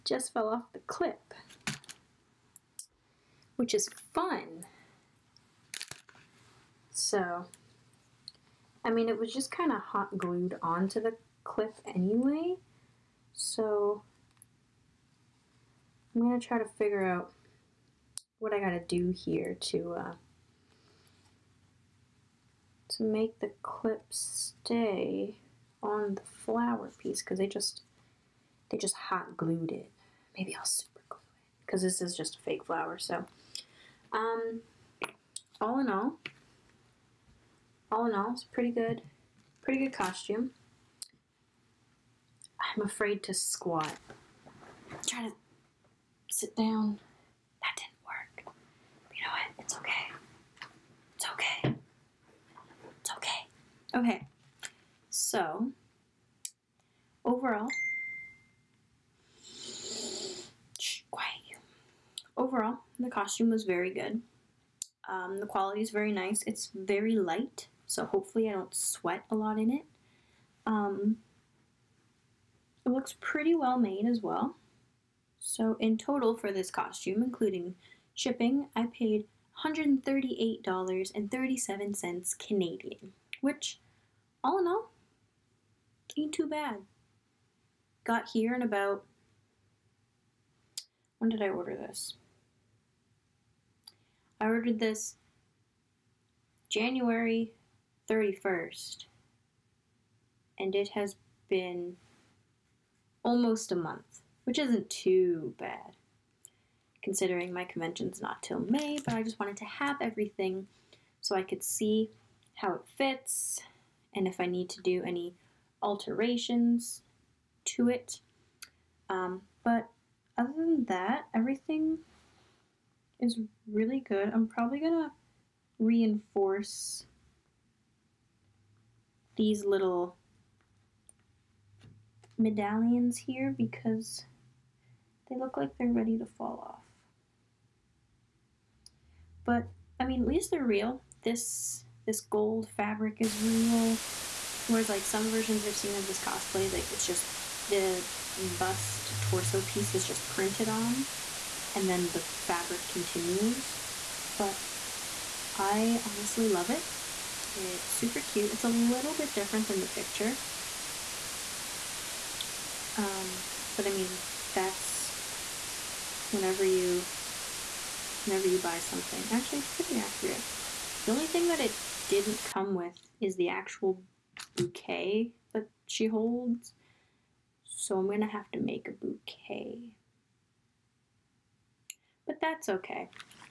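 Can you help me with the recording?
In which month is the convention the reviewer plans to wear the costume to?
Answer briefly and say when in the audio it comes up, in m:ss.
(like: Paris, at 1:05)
May, at 1:48.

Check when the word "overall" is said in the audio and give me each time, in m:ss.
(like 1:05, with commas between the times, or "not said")
0:57, 1:02.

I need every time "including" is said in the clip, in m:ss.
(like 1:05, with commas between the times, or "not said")
1:17.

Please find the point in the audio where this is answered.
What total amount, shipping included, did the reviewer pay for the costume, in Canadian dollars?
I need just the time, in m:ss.
1:19.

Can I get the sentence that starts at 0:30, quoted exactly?
Maybe I'll super glue it because this is just a fake flower.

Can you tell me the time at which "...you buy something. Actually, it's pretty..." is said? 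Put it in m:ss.
2:48.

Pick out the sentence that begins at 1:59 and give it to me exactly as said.
Um, but other than that, everything is really good.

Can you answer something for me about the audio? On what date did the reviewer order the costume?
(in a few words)
January 31st.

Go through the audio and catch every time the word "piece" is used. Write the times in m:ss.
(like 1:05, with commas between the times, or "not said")
0:26, 2:29.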